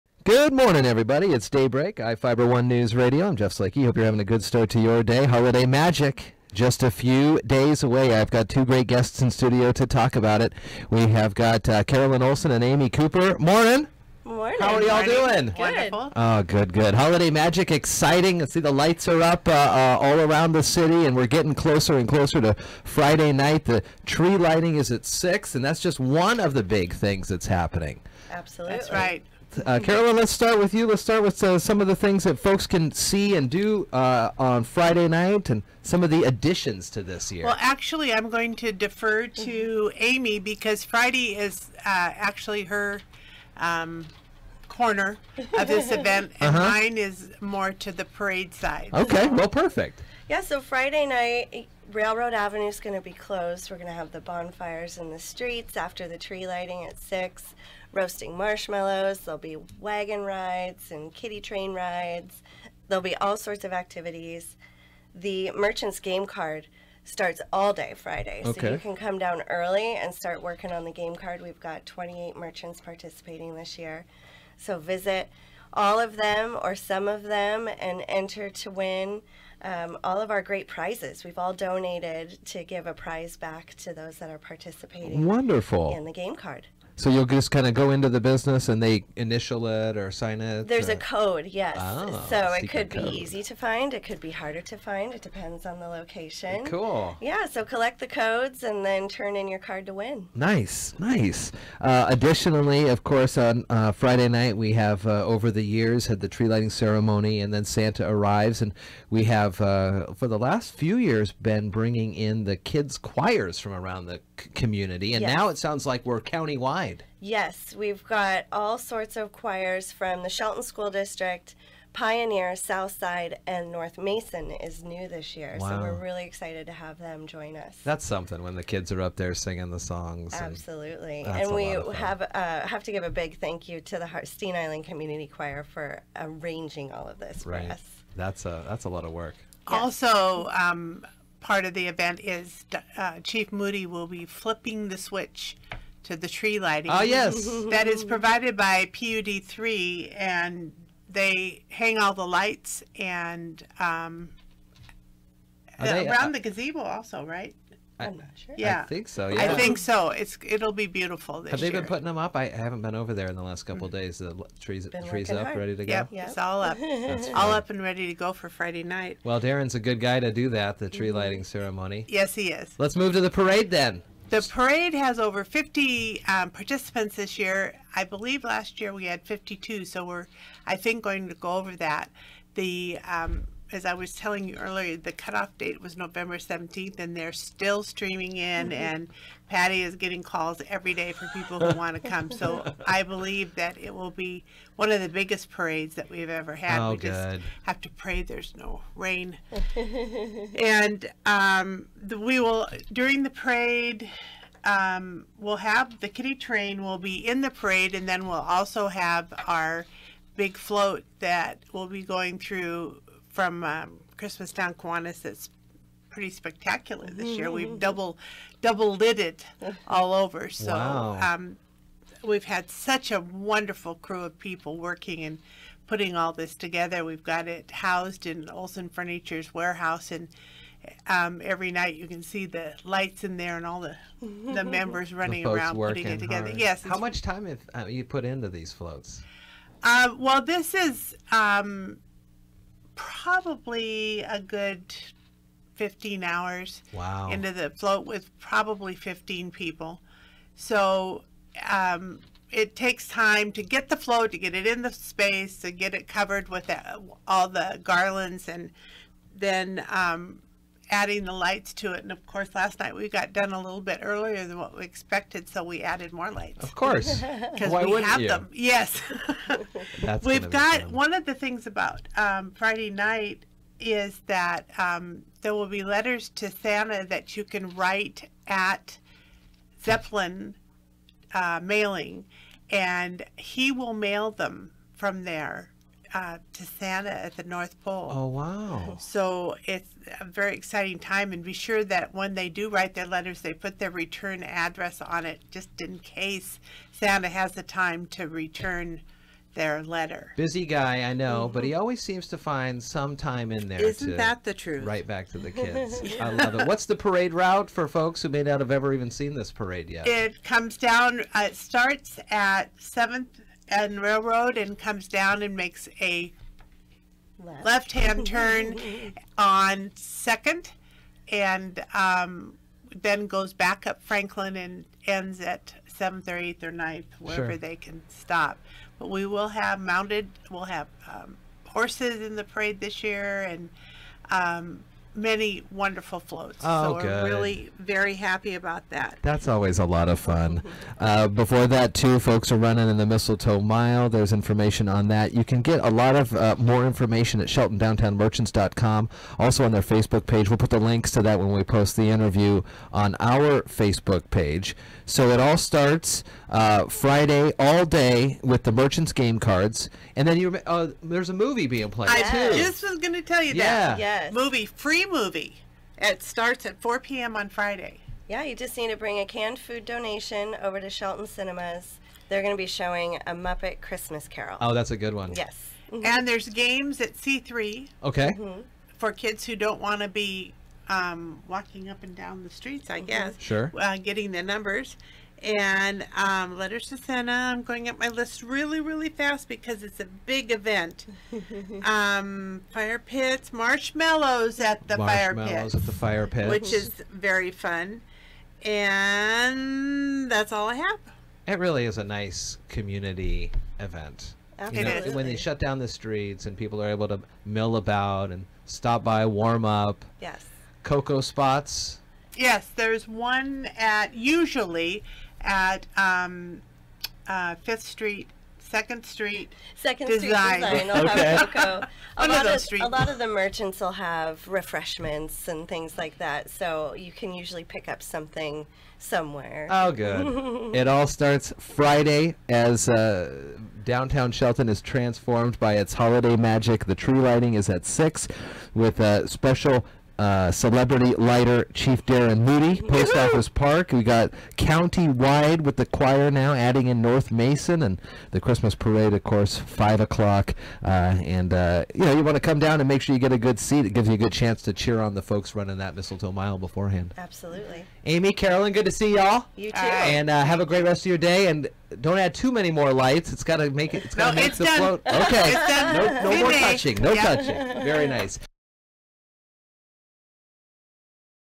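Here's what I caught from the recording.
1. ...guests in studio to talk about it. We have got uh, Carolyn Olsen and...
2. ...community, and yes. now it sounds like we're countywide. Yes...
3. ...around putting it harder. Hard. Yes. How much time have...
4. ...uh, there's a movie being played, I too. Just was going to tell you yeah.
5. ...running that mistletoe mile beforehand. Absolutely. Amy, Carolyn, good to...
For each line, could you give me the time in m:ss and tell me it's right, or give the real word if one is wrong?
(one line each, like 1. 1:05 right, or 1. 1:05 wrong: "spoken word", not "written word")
1. 0:08 right
2. 1:54 right
3. 3:55 wrong: "together", not "harder"
4. 6:00 right
5. 7:35 right.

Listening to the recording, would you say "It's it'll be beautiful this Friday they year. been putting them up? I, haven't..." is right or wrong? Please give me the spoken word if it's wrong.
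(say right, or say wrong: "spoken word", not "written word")
wrong: "Have", not "Friday".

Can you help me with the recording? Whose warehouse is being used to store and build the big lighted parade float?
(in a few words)
Olsen Furniture.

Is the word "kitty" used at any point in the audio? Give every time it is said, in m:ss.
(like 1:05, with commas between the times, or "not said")
1:01, 3:26.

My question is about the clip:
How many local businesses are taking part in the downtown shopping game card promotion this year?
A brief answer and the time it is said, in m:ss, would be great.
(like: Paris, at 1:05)
28, at 1:11.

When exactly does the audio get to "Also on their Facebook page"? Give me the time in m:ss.
5:49.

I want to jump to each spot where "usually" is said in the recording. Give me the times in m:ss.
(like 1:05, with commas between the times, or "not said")
6:54, 7:07.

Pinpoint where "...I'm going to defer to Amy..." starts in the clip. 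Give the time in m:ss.
0:38.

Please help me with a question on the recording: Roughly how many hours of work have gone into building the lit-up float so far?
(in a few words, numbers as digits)
15 hours.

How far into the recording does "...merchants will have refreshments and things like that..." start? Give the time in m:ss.
7:03.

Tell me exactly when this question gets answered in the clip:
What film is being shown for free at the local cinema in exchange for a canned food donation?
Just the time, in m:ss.
6:13.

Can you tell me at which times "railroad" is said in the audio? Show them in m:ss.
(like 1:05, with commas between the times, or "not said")
0:51, 5:14.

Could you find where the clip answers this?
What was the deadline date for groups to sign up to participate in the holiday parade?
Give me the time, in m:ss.
3:05.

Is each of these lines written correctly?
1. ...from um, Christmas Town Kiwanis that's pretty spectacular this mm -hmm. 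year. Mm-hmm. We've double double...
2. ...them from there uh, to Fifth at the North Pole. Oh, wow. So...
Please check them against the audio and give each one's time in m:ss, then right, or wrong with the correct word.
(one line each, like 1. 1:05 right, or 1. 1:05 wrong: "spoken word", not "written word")
1. 3:33 right
2. 4:44 wrong: "Santa", not "Fifth".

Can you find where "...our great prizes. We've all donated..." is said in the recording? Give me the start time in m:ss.
1:20.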